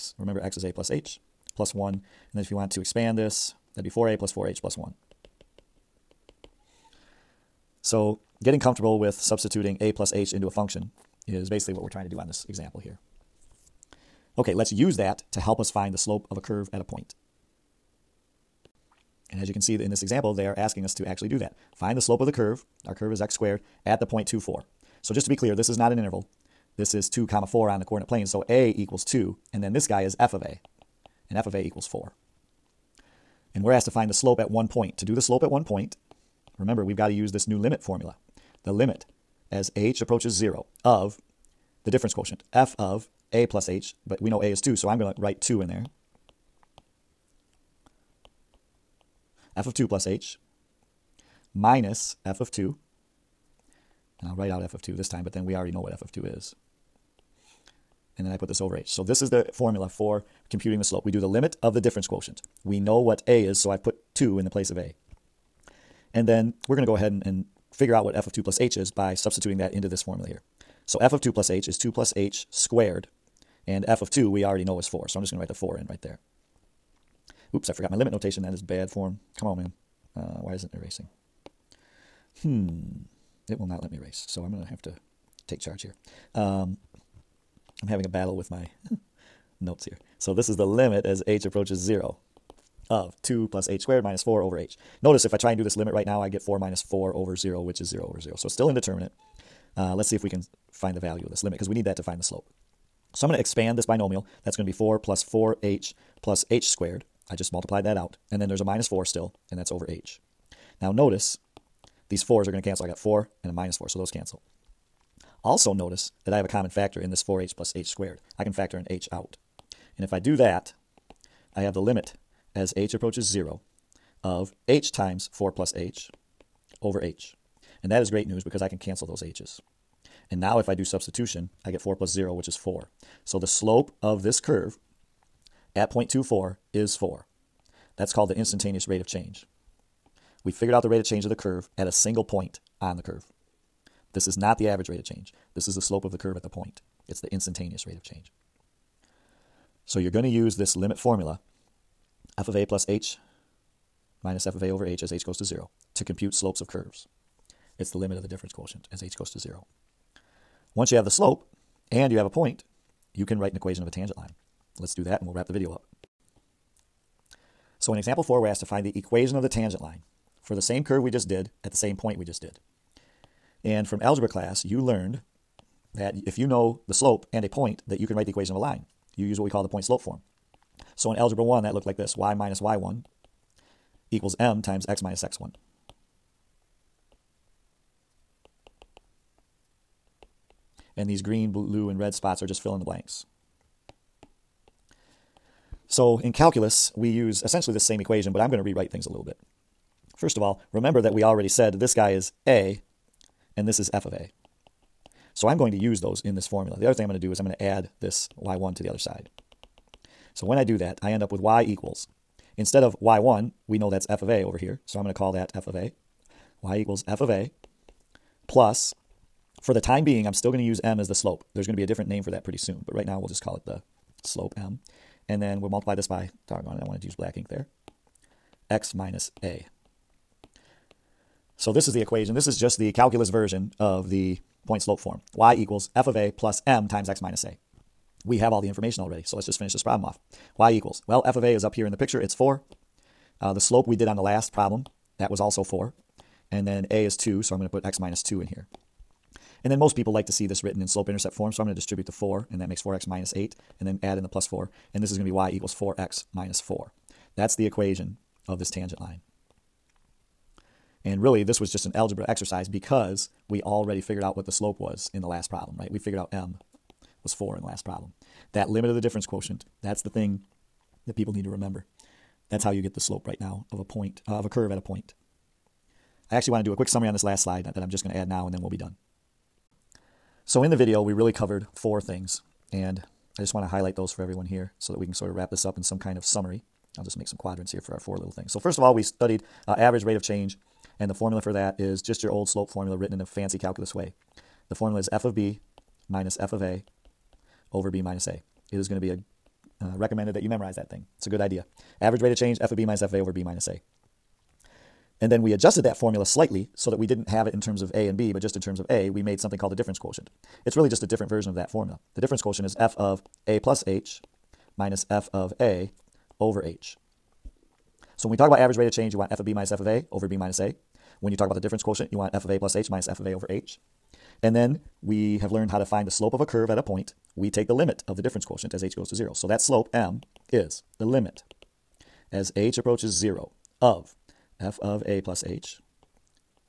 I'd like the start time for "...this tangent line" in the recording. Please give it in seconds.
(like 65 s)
258 s.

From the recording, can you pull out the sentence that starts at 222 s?
But right now, we'll just call it the slope m.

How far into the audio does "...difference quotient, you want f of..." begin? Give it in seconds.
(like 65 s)
321 s.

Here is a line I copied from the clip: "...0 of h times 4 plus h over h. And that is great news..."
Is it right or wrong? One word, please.
right.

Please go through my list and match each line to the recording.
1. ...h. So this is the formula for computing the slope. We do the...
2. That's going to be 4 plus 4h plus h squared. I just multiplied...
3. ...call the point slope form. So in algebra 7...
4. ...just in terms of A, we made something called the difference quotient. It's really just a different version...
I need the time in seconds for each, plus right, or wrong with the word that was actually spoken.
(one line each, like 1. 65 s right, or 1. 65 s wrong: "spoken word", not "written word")
1. 58 s right
2. 104 s right
3. 179 s wrong: "1", not "7"
4. 308 s right.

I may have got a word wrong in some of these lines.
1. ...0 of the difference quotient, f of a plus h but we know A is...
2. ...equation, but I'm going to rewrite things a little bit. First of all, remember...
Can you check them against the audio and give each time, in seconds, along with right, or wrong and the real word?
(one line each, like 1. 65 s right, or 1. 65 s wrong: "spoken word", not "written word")
1. 40 s right
2. 197 s right.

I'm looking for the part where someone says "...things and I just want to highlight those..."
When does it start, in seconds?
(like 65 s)
281 s.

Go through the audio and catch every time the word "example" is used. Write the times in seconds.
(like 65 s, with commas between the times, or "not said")
12 s, 20 s, 167 s.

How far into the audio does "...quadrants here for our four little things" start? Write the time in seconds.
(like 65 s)
287 s.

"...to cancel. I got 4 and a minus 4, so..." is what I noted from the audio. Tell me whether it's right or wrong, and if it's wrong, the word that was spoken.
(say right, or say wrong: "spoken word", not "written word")
right.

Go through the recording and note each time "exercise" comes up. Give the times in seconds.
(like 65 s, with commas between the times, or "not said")
262 s.